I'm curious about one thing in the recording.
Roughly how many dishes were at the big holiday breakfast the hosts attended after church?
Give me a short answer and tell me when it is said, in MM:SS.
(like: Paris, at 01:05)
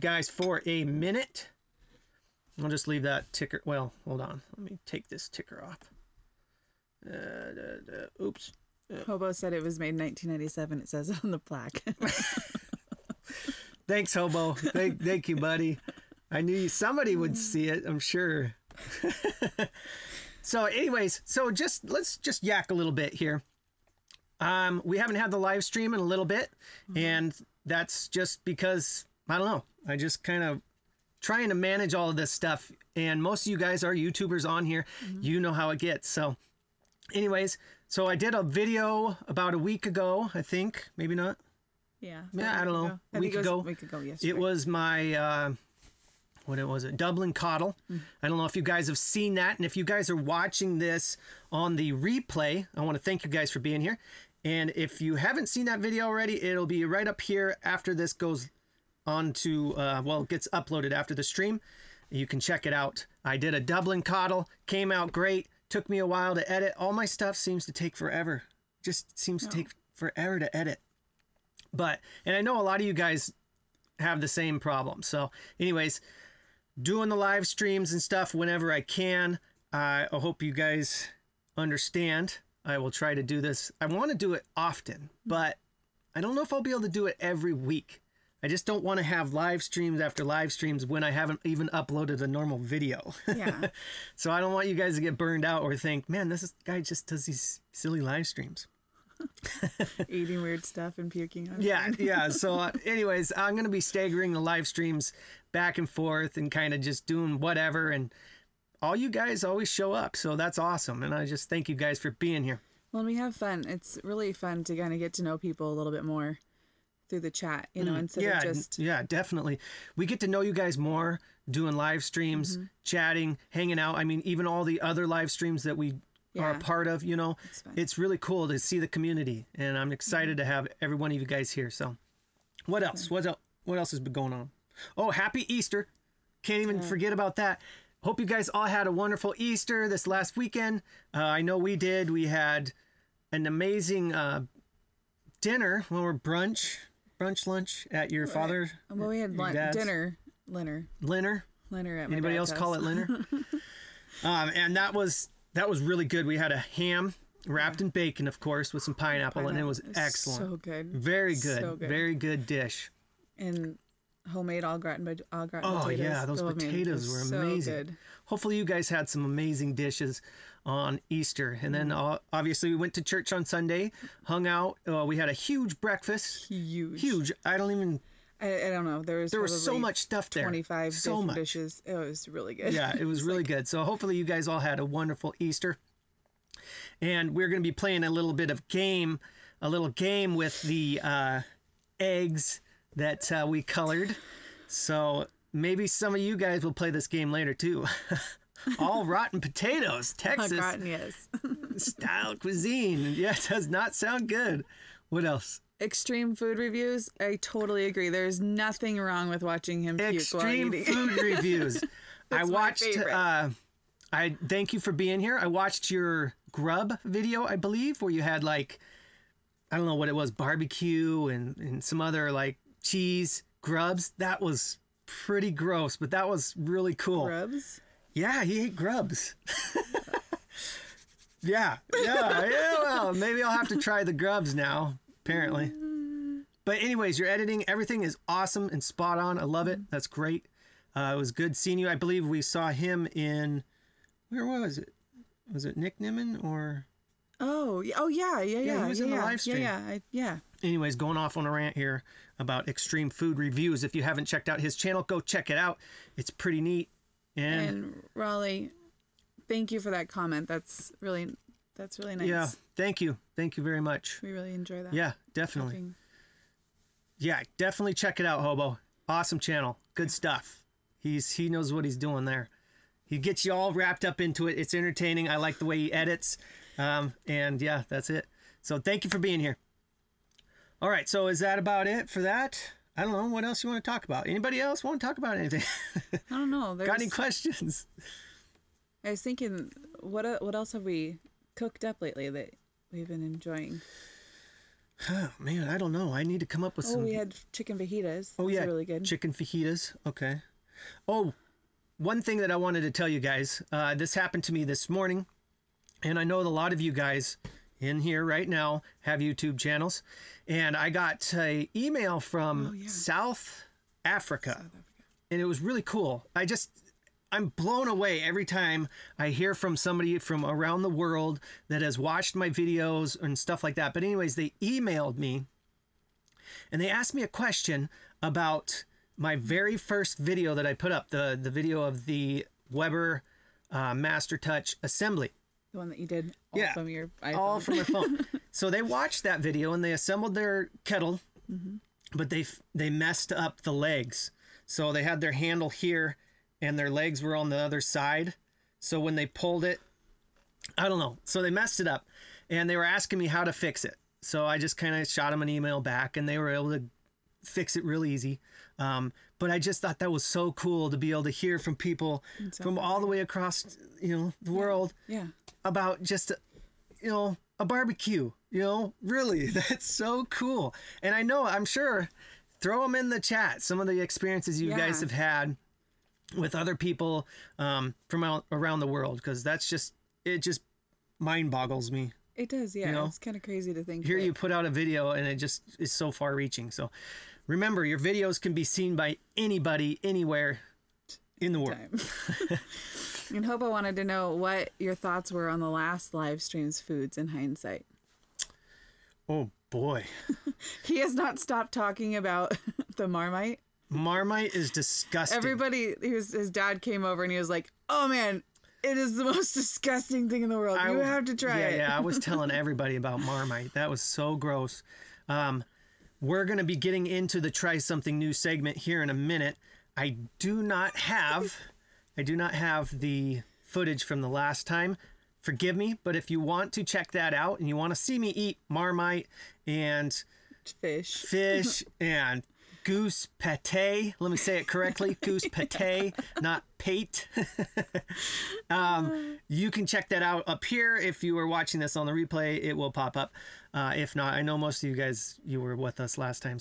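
25, at 03:00.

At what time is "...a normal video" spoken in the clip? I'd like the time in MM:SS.
01:32.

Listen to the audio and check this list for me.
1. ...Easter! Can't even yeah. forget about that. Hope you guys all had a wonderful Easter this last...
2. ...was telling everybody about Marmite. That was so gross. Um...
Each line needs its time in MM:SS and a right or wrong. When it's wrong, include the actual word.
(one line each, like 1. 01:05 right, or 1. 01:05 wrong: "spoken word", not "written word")
1. 02:15 right
2. 06:51 right.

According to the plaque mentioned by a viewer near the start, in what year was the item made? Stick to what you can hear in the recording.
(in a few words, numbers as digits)
1997.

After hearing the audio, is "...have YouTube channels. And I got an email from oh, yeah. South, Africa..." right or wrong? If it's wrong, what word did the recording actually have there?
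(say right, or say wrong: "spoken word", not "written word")
right.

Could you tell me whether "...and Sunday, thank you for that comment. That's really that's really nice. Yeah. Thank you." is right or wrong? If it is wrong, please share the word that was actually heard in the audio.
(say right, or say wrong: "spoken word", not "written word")
wrong: "Raleigh", not "Sunday".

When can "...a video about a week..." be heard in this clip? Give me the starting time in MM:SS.
00:38.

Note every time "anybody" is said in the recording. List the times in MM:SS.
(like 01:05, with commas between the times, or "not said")
02:32, 04:44, 06:29.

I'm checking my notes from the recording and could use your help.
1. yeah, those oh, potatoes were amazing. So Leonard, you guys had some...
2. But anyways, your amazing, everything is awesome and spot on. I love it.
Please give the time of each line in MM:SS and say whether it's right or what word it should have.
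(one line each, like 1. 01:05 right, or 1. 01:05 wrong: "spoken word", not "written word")
1. 02:46 wrong: "Hopefully", not "Leonard"
2. 03:56 wrong: "editing", not "amazing".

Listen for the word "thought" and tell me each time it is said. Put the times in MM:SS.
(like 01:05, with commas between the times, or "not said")
05:59, 06:34.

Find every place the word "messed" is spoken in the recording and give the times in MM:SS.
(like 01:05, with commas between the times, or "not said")
05:42, 05:51.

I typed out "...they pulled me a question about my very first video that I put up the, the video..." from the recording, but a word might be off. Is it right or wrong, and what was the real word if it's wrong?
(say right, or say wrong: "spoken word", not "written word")
wrong: "asked", not "pulled".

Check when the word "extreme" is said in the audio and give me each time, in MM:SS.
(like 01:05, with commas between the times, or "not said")
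03:25, 03:29, 04:12.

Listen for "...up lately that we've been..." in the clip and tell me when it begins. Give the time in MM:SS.
04:51.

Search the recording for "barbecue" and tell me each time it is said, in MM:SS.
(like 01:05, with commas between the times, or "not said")
03:40, 06:07.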